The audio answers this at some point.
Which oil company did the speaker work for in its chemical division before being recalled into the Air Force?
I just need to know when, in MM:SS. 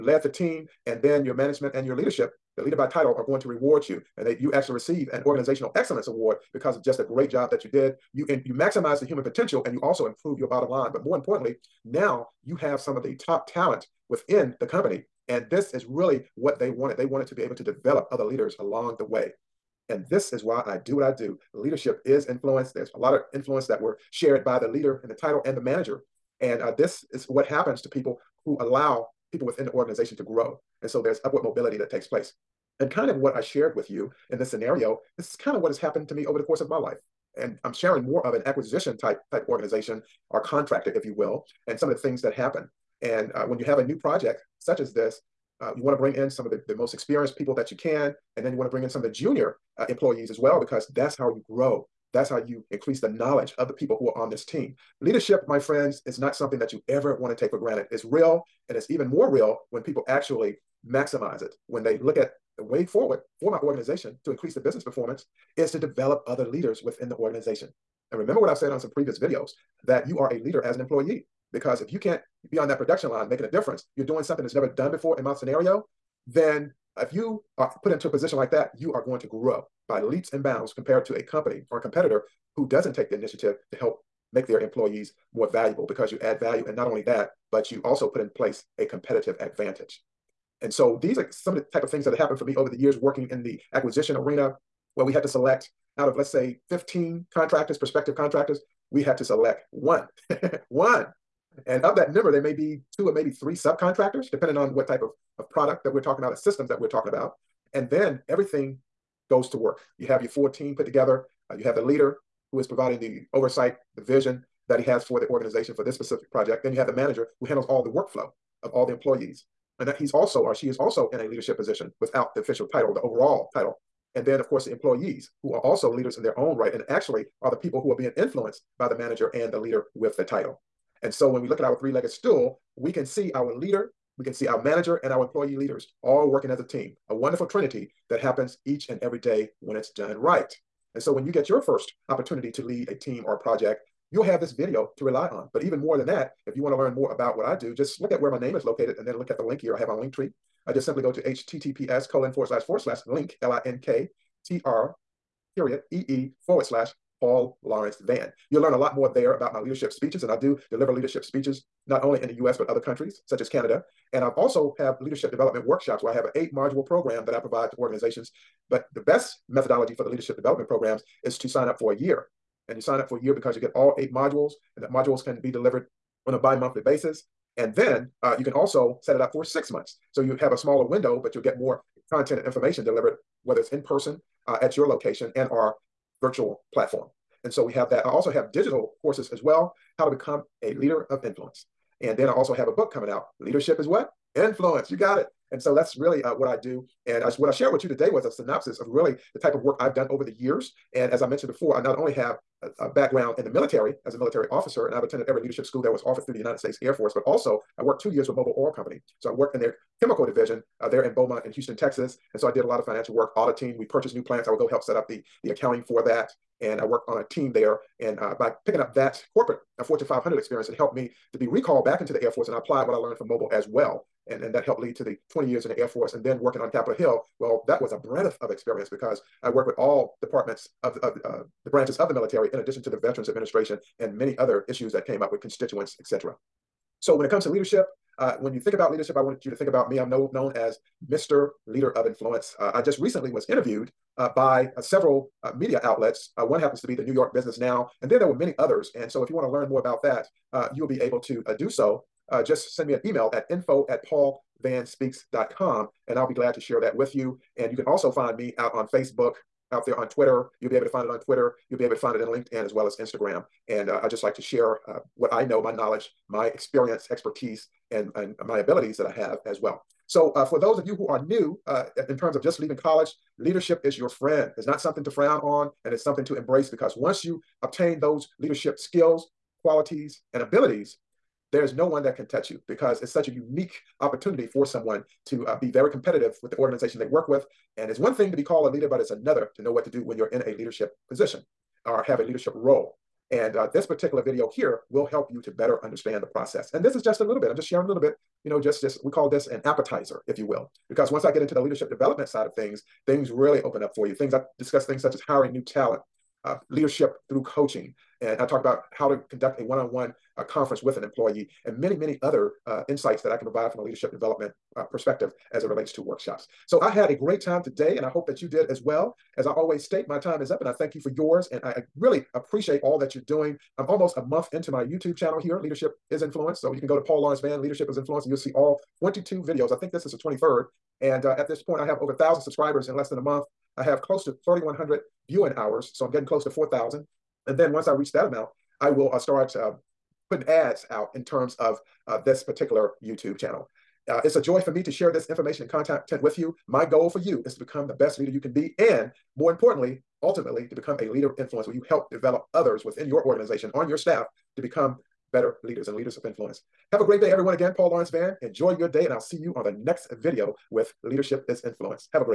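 03:28.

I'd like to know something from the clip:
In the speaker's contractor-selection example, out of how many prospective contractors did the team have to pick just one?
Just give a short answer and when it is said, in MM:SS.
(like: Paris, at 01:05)
15, at 01:36.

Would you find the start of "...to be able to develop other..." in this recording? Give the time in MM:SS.
00:17.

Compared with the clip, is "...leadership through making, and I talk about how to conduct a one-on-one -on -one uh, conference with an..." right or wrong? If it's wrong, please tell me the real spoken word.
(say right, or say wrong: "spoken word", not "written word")
wrong: "coaching", not "making".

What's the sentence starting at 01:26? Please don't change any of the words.
And not only that, but you also put in place a competitive advantage.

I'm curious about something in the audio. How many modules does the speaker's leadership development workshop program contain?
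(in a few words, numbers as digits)
8.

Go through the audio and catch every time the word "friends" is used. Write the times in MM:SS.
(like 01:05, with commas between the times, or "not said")
00:55, 04:34.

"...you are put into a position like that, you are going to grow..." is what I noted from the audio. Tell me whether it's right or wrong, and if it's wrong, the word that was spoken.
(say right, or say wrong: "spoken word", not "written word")
right.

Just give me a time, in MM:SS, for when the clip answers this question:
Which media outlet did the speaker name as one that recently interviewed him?
04:07.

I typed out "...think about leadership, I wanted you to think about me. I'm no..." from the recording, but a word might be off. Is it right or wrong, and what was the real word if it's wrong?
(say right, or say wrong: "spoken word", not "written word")
right.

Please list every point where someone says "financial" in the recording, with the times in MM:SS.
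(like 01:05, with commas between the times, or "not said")
03:32.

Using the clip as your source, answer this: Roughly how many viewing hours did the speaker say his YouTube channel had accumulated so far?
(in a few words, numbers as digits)
3,100.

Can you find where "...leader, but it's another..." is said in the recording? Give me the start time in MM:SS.
04:48.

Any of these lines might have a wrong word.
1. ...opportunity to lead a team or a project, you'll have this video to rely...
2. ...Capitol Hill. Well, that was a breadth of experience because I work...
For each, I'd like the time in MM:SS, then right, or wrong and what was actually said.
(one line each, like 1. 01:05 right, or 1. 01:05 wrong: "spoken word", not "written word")
1. 02:22 right
2. 03:46 right.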